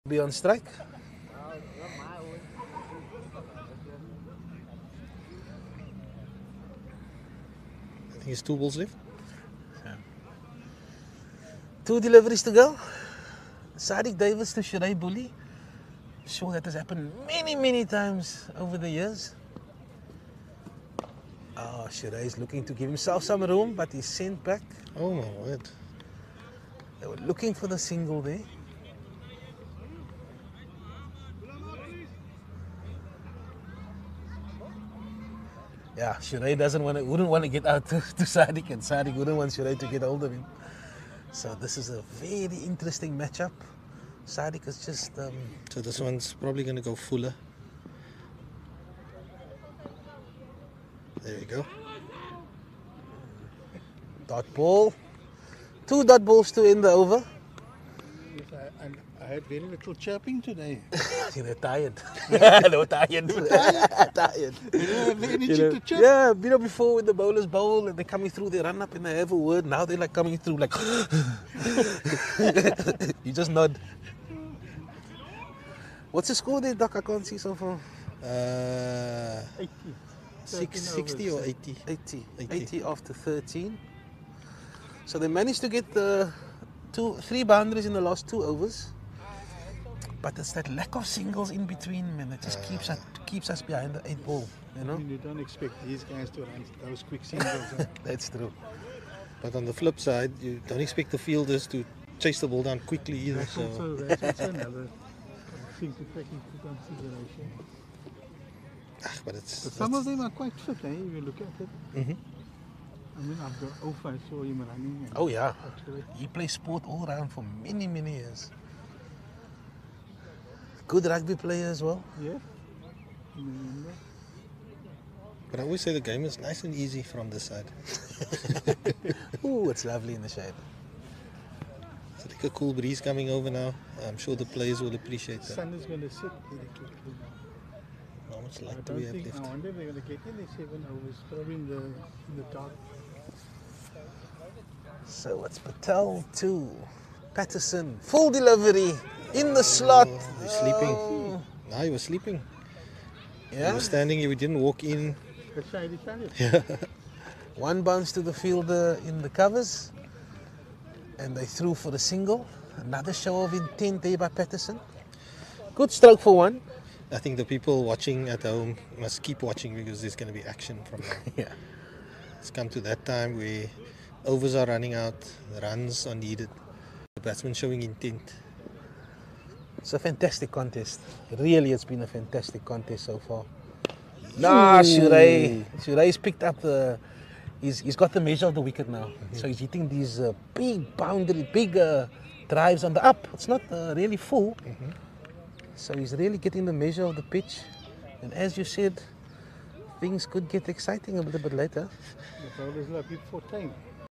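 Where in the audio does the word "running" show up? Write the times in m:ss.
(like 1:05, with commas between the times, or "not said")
1:54, 2:54.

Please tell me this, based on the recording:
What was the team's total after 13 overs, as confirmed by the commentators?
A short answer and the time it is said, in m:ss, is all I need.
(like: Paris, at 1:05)
80, at 1:22.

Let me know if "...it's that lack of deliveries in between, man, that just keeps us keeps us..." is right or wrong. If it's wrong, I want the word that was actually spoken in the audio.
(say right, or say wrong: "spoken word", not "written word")
wrong: "singles", not "deliveries".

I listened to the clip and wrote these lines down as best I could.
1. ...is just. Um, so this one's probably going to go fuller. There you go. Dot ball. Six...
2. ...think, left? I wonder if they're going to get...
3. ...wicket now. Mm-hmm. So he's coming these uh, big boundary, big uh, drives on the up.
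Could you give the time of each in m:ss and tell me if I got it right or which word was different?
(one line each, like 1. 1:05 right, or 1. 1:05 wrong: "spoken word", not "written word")
1. 0:44 wrong: "Two", not "Six"
2. 2:19 right
3. 3:08 wrong: "hitting", not "coming".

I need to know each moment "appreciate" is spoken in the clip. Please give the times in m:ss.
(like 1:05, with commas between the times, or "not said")
2:14.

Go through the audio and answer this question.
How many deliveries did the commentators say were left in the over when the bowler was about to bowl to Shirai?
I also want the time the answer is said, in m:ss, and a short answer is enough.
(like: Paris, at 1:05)
2, at 0:11.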